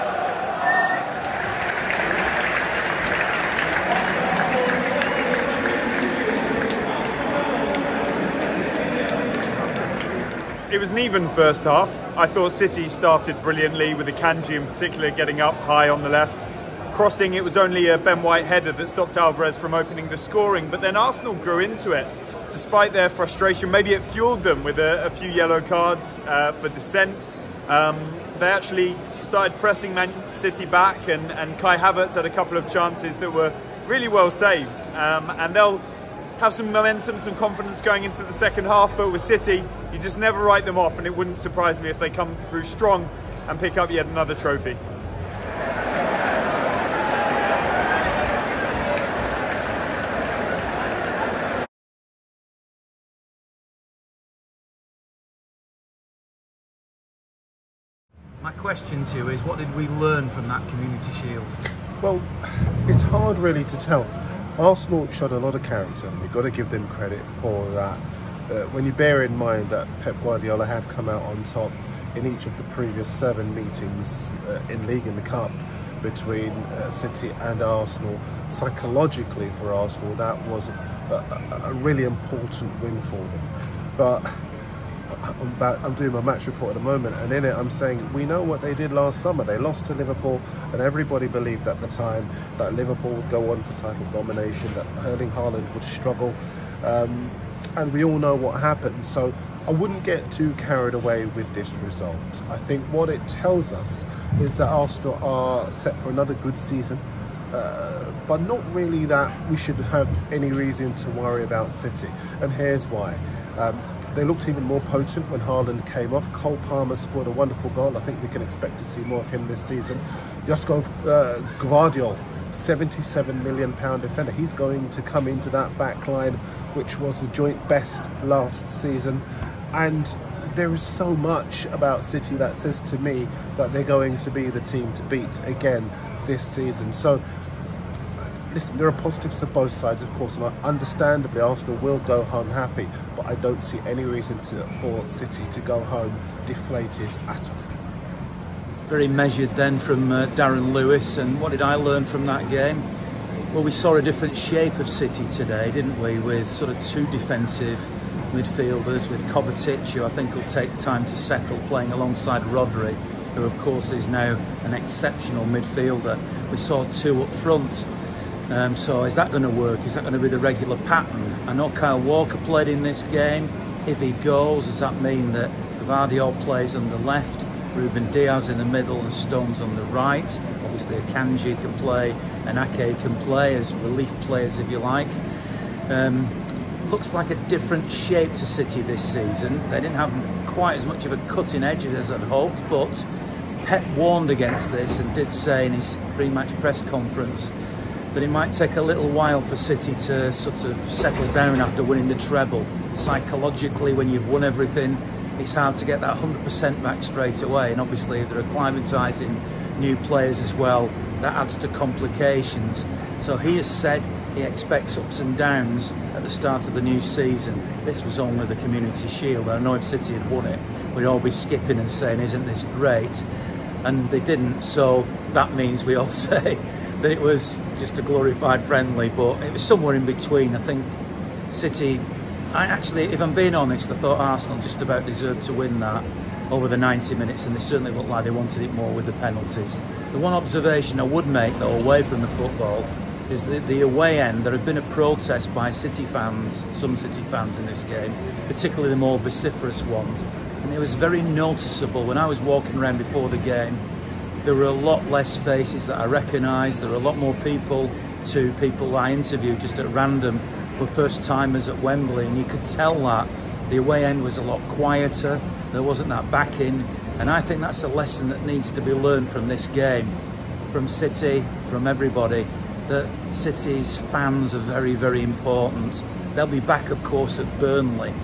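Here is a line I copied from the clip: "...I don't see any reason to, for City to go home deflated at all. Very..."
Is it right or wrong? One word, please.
right.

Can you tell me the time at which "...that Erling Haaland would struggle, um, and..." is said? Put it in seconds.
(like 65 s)
94 s.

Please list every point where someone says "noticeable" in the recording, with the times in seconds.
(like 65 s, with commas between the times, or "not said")
251 s.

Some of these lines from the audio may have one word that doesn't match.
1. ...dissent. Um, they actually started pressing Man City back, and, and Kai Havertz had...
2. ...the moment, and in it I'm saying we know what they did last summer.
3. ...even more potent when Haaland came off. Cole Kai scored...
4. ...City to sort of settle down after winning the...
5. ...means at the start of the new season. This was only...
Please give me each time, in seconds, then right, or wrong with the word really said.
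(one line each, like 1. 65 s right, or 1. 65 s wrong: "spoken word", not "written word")
1. 26 s right
2. 86 s right
3. 114 s wrong: "Palmer", not "Kai"
4. 199 s right
5. 215 s wrong: "downs", not "means".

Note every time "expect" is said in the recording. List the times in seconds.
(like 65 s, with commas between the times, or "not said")
118 s, 214 s.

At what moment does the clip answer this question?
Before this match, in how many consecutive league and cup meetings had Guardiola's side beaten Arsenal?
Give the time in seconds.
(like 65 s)
73 s.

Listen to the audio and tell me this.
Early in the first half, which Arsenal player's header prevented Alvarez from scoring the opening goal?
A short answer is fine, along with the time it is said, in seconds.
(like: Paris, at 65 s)
Ben White, at 17 s.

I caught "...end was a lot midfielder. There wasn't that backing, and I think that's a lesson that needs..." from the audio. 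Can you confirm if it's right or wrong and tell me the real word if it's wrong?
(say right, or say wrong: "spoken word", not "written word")
wrong: "quieter", not "midfielder".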